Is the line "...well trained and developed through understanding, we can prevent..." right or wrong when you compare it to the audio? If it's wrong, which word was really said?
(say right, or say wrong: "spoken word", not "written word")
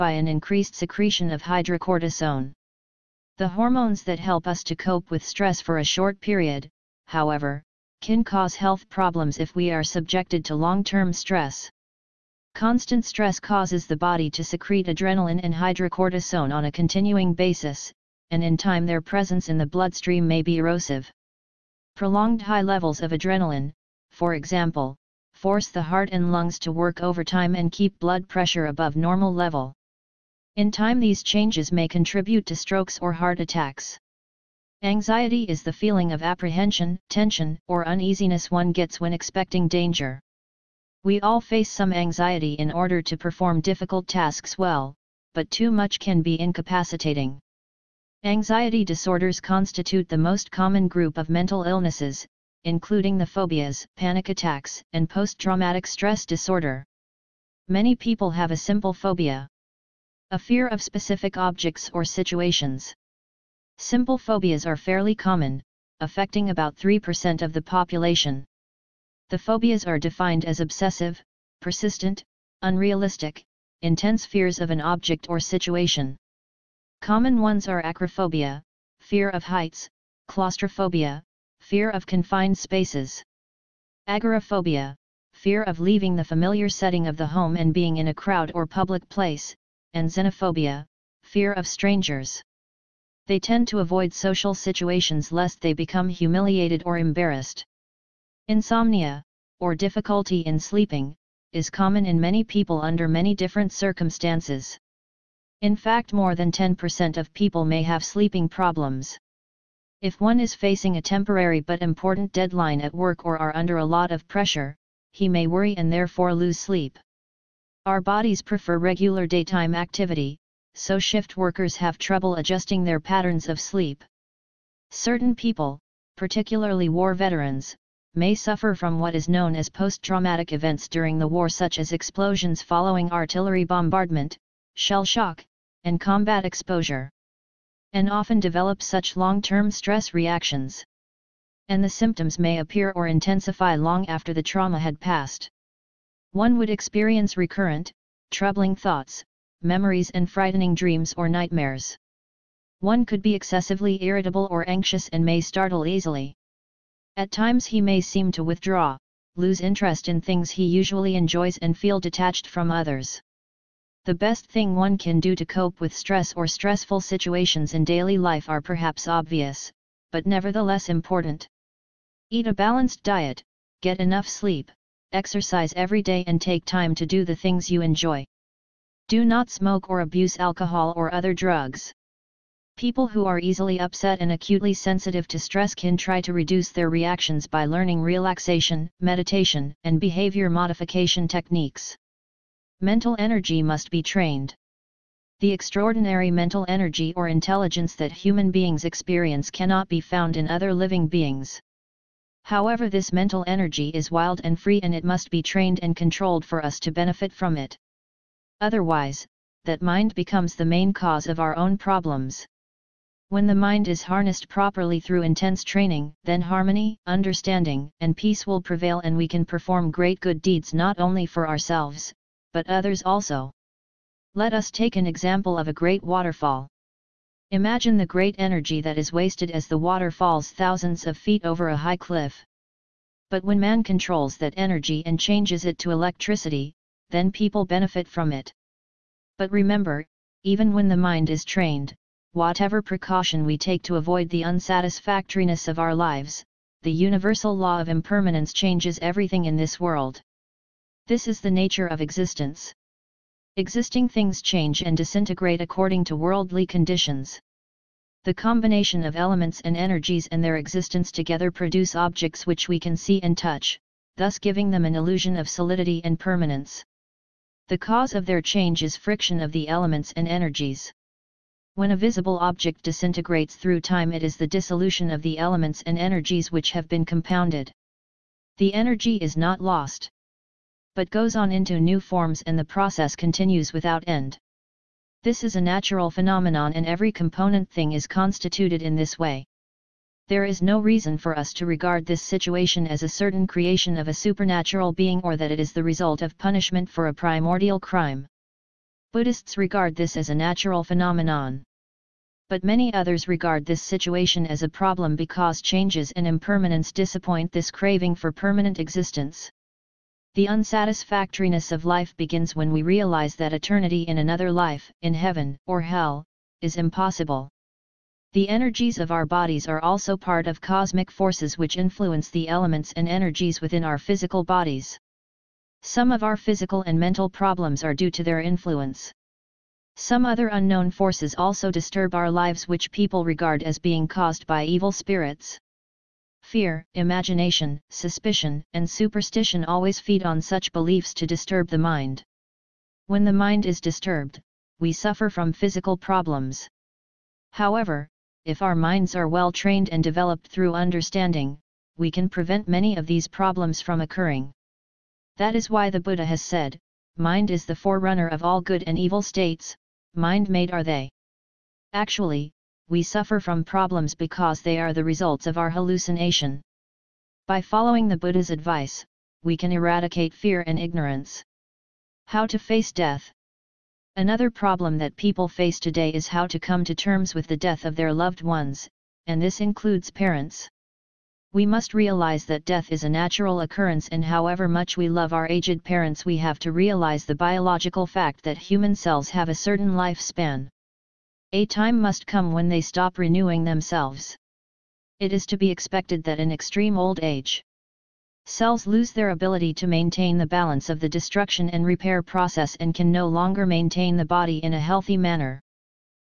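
right.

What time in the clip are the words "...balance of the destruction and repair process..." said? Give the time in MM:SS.
06:40.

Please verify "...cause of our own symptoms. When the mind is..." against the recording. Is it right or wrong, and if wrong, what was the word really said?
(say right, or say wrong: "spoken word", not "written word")
wrong: "problems", not "symptoms".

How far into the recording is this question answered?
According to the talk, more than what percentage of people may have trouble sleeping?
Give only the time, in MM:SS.
01:46.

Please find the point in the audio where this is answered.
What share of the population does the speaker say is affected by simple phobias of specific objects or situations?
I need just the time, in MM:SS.
01:06.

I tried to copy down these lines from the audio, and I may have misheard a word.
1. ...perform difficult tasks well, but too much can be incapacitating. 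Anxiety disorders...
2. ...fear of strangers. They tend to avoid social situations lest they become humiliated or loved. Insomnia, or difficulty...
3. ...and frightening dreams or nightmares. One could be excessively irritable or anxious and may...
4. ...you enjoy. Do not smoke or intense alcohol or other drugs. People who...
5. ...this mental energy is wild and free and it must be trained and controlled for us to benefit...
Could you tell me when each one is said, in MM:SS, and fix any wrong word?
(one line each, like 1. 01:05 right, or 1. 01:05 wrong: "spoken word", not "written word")
1. 00:43 right
2. 01:31 wrong: "embarrassed", not "loved"
3. 02:30 right
4. 02:57 wrong: "abuse", not "intense"
5. 03:22 right.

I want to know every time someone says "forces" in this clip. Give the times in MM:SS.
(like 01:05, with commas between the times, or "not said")
00:25, 05:21, 05:30.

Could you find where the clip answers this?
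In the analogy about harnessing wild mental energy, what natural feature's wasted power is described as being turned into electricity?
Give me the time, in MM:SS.
03:45.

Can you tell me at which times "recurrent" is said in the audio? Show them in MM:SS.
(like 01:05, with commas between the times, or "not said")
02:27.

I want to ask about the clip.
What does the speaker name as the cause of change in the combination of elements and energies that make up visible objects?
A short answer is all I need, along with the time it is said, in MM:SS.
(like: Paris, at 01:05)
friction, at 04:28.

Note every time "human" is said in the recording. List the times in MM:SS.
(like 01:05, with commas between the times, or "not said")
03:18, 06:28.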